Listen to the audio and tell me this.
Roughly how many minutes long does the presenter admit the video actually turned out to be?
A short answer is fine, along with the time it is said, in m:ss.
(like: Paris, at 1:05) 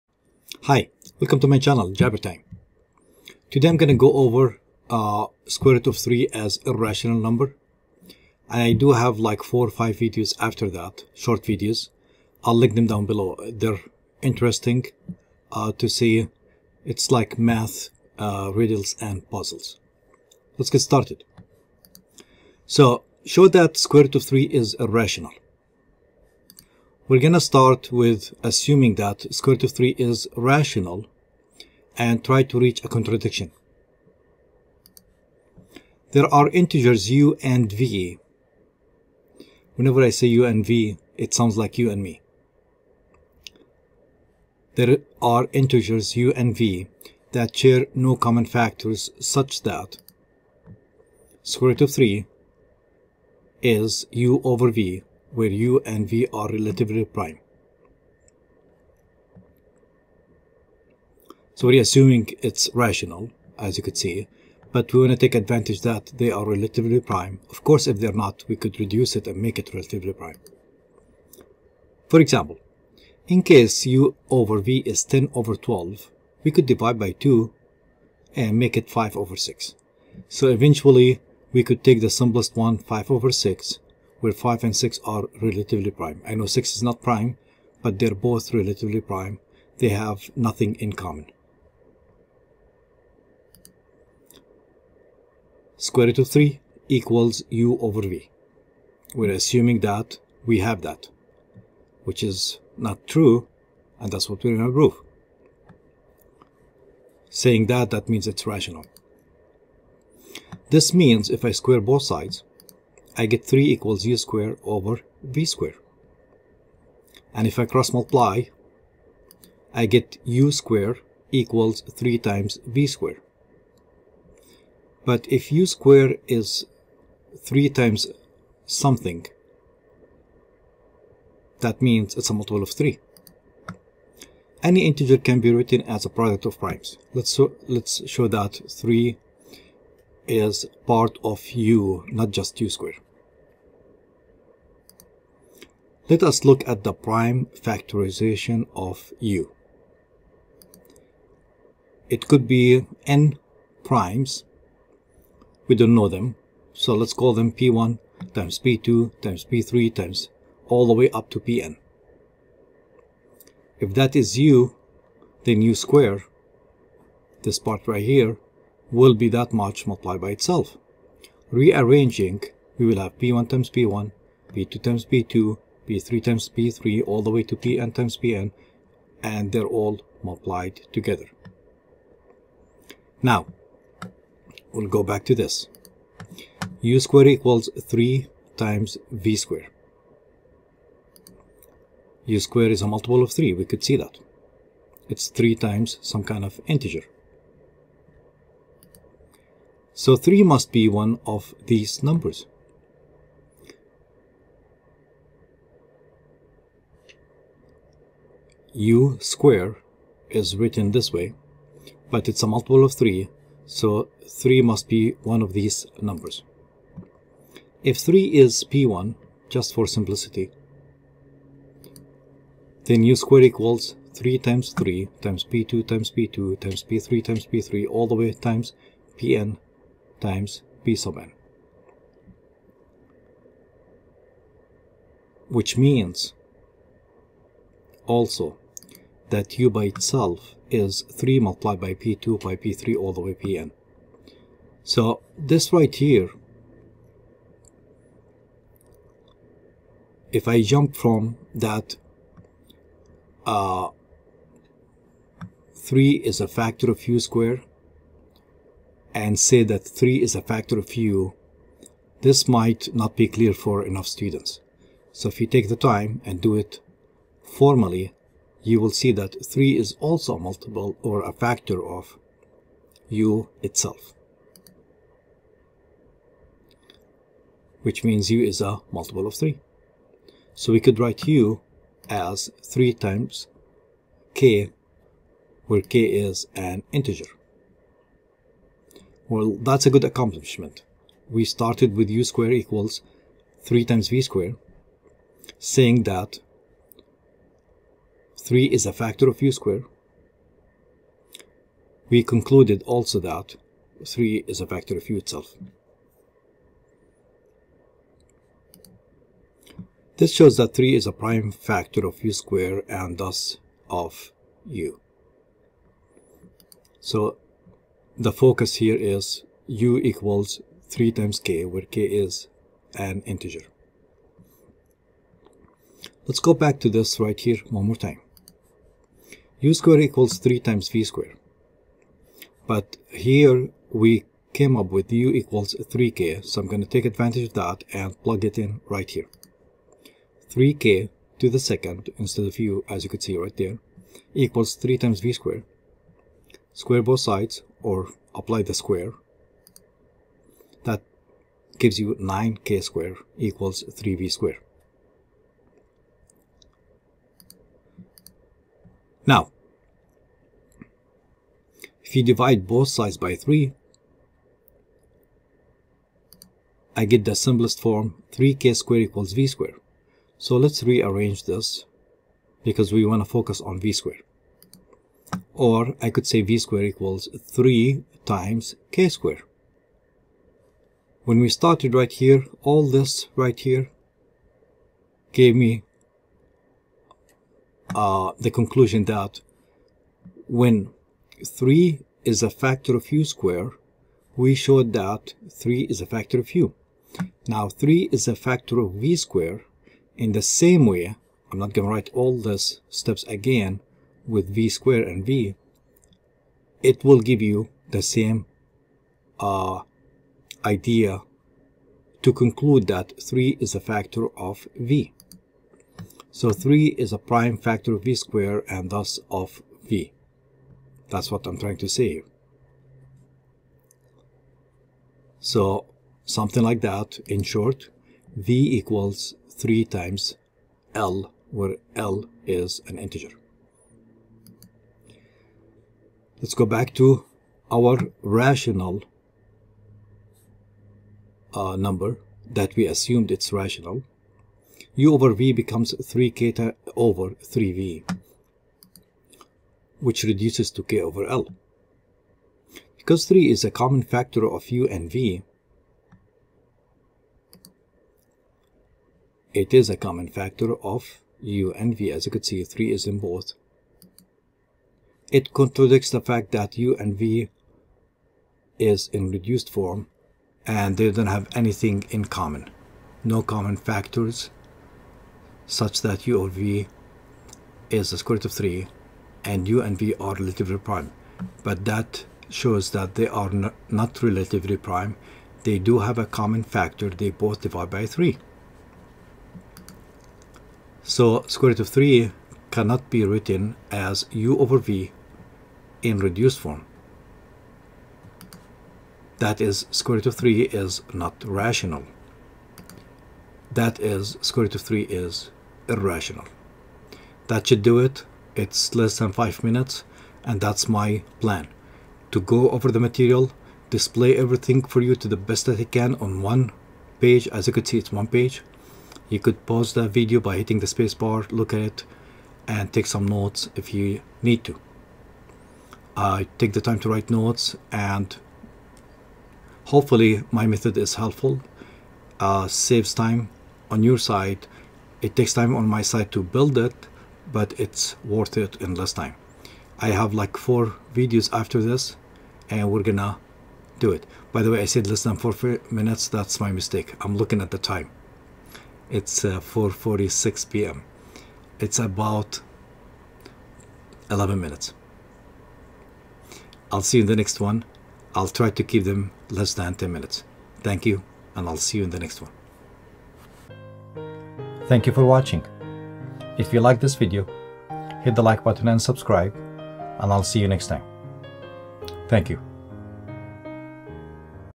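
11, at 9:14.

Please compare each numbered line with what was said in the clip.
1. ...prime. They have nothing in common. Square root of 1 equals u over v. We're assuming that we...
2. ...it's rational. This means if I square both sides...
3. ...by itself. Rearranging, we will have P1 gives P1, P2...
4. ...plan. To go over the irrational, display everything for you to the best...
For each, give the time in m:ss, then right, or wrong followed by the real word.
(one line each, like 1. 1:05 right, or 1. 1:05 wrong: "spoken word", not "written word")
1. 1:29 wrong: "3", not "1"
2. 1:48 right
3. 2:50 wrong: "times", not "gives"
4. 8:31 wrong: "material", not "irrational".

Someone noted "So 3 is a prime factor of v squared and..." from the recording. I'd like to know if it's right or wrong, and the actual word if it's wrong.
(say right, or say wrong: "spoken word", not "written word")
right.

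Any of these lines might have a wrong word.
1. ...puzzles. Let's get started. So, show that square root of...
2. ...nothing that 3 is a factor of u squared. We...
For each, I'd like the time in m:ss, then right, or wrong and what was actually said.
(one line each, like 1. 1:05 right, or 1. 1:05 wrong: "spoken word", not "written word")
1. 0:19 right
2. 4:55 wrong: "saying", not "nothing".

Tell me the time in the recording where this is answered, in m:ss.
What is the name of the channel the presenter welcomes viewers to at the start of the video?
0:01.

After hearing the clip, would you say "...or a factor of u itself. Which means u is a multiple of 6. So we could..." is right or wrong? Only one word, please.
wrong.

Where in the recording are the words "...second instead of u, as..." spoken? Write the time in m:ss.
5:41.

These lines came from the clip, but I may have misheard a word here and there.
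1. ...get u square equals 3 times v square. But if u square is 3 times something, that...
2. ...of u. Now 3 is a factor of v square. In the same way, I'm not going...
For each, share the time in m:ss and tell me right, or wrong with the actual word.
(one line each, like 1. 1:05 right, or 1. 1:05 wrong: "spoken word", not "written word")
1. 1:59 right
2. 6:36 right.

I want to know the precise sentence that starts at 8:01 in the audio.
But that shows that they are not relatively prime.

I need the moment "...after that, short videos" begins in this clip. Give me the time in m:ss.
0:10.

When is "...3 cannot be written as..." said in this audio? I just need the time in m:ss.
8:11.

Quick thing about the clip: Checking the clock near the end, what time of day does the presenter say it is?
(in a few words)
4:46 p.m.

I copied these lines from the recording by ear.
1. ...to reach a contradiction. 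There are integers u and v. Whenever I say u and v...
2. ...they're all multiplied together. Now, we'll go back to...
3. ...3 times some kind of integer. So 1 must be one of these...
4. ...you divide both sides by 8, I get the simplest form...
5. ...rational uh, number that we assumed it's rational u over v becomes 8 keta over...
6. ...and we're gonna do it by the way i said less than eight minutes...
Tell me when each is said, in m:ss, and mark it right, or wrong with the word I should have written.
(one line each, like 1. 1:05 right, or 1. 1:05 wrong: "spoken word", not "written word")
1. 0:32 right
2. 2:59 right
3. 3:15 wrong: "3", not "1"
4. 6:02 wrong: "3", not "8"
5. 7:18 wrong: "3", not "8"
6. 9:02 wrong: "four", not "eight".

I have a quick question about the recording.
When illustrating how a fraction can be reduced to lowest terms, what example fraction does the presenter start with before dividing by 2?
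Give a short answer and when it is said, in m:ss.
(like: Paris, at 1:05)
10/12, at 1:15.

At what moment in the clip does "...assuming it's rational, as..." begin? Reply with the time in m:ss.
1:01.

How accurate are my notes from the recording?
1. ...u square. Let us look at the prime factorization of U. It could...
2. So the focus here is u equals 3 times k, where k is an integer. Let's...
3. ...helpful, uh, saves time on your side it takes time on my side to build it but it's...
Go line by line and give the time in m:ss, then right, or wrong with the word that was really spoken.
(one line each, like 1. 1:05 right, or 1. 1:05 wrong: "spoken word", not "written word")
1. 2:22 right
2. 5:16 right
3. 8:51 right.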